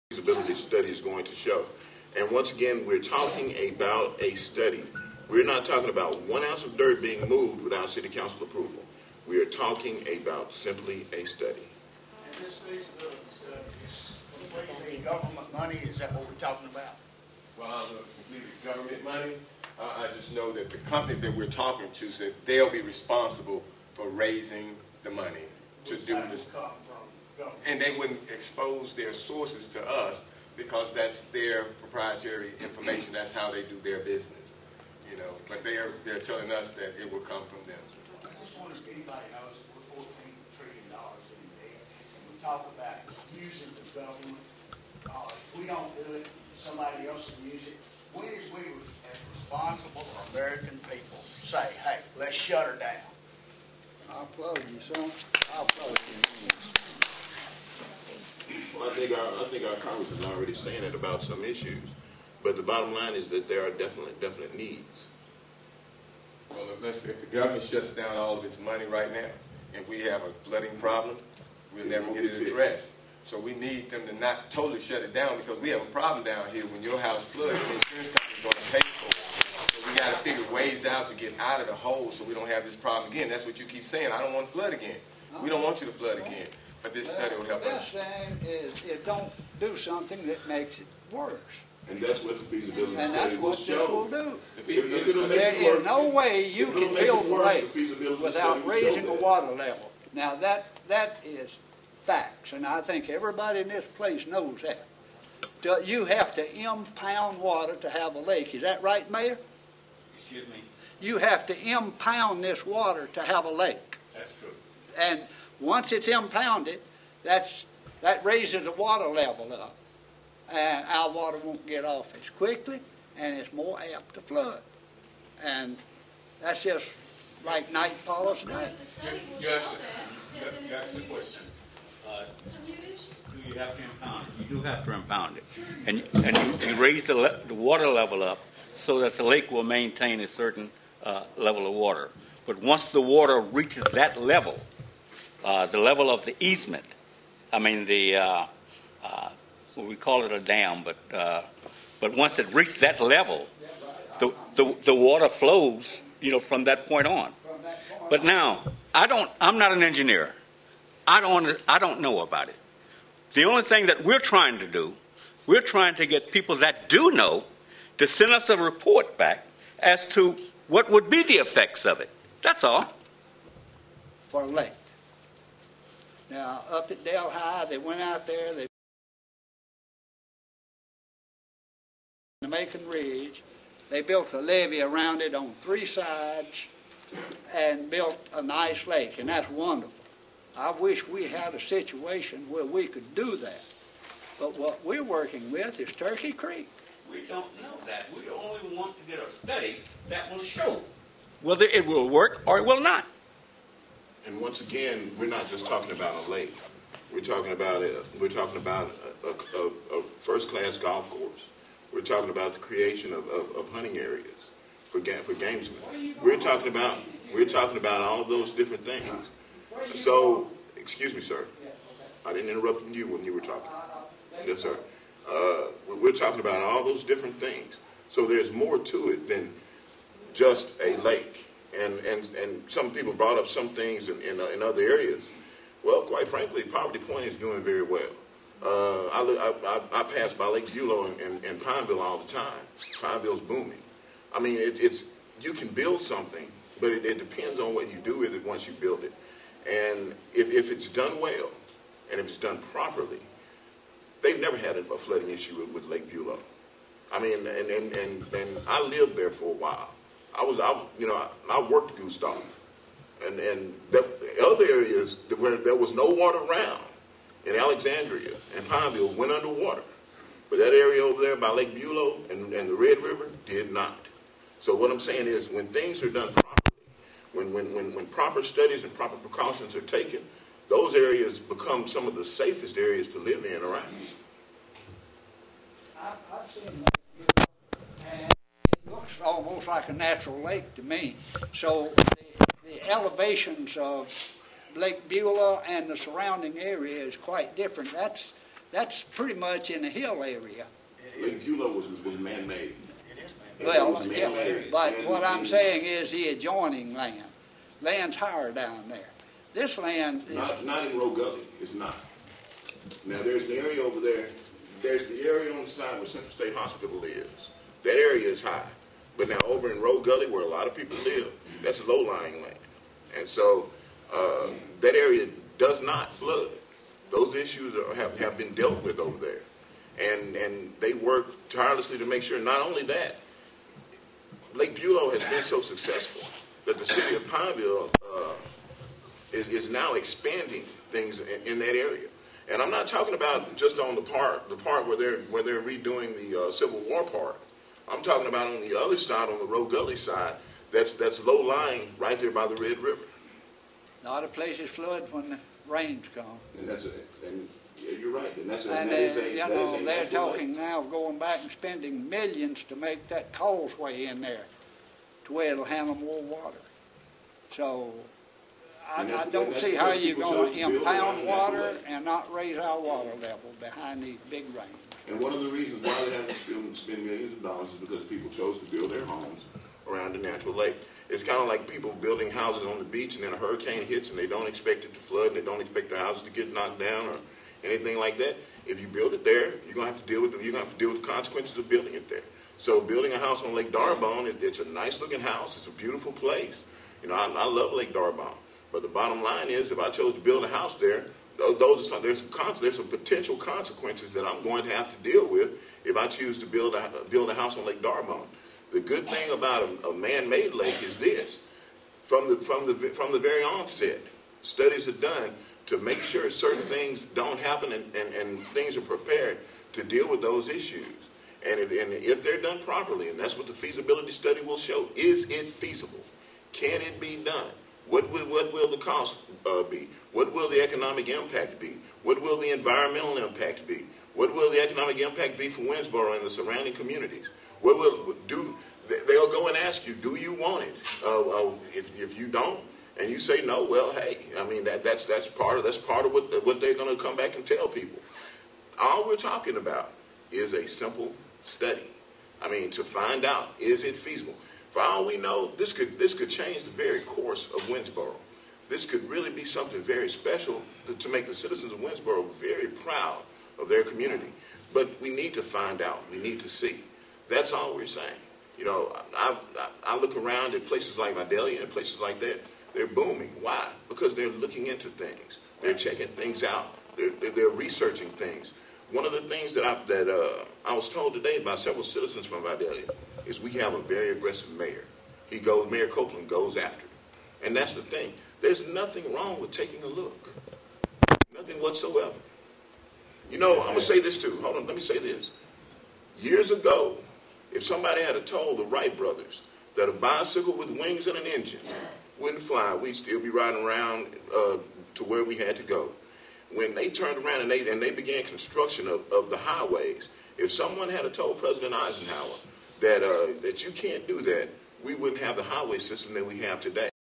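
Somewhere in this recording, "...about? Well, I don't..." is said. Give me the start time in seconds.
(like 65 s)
16 s.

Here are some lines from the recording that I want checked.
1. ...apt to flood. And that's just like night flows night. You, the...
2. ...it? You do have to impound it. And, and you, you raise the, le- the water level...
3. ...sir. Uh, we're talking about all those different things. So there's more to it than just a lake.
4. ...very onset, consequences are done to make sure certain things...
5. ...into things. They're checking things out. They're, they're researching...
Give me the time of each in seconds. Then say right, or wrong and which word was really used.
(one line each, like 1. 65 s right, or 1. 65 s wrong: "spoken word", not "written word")
1. 123 s wrong: "follows", not "flows"
2. 134 s right
3. 224 s right
4. 413 s wrong: "studies", not "consequences"
5. 474 s right.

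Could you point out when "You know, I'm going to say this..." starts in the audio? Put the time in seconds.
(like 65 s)
493 s.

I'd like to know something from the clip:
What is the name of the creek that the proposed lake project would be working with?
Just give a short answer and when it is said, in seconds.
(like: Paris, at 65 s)
Turkey Creek, at 195 s.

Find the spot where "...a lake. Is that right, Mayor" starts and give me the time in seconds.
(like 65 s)
108 s.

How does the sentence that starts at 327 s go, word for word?
Those issues are, have, have been dealt with over there.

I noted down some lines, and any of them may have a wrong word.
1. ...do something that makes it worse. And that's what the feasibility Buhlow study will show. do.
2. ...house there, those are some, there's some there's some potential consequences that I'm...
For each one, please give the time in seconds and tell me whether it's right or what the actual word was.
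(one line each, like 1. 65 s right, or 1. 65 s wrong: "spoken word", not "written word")
1. 89 s wrong: "And", not "Buhlow"
2. 400 s right.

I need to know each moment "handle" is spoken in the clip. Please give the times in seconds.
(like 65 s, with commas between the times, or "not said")
365 s.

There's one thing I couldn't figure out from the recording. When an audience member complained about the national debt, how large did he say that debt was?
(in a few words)
14 trillion dollars.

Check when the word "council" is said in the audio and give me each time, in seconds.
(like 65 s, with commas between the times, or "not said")
8 s.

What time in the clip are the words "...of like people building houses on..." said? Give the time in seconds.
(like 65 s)
381 s.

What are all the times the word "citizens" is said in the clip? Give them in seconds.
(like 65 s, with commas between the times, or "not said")
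461 s, 481 s.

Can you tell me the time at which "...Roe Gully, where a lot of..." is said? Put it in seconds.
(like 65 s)
319 s.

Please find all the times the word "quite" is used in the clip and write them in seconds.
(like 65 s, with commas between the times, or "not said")
236 s, 297 s.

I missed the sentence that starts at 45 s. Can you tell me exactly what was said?
Uh, we don't do it, somebody else will use it.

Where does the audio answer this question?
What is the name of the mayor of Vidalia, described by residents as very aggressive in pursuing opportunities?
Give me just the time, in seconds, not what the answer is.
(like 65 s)
485 s.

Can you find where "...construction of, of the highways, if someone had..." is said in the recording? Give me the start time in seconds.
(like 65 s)
508 s.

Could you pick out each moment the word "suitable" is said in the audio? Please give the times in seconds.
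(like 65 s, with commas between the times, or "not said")
not said.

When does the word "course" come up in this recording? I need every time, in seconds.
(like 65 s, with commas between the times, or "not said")
211 s, 457 s.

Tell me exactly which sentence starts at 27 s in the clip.
And they wouldn't expose their sources to us because that's their proprietary information.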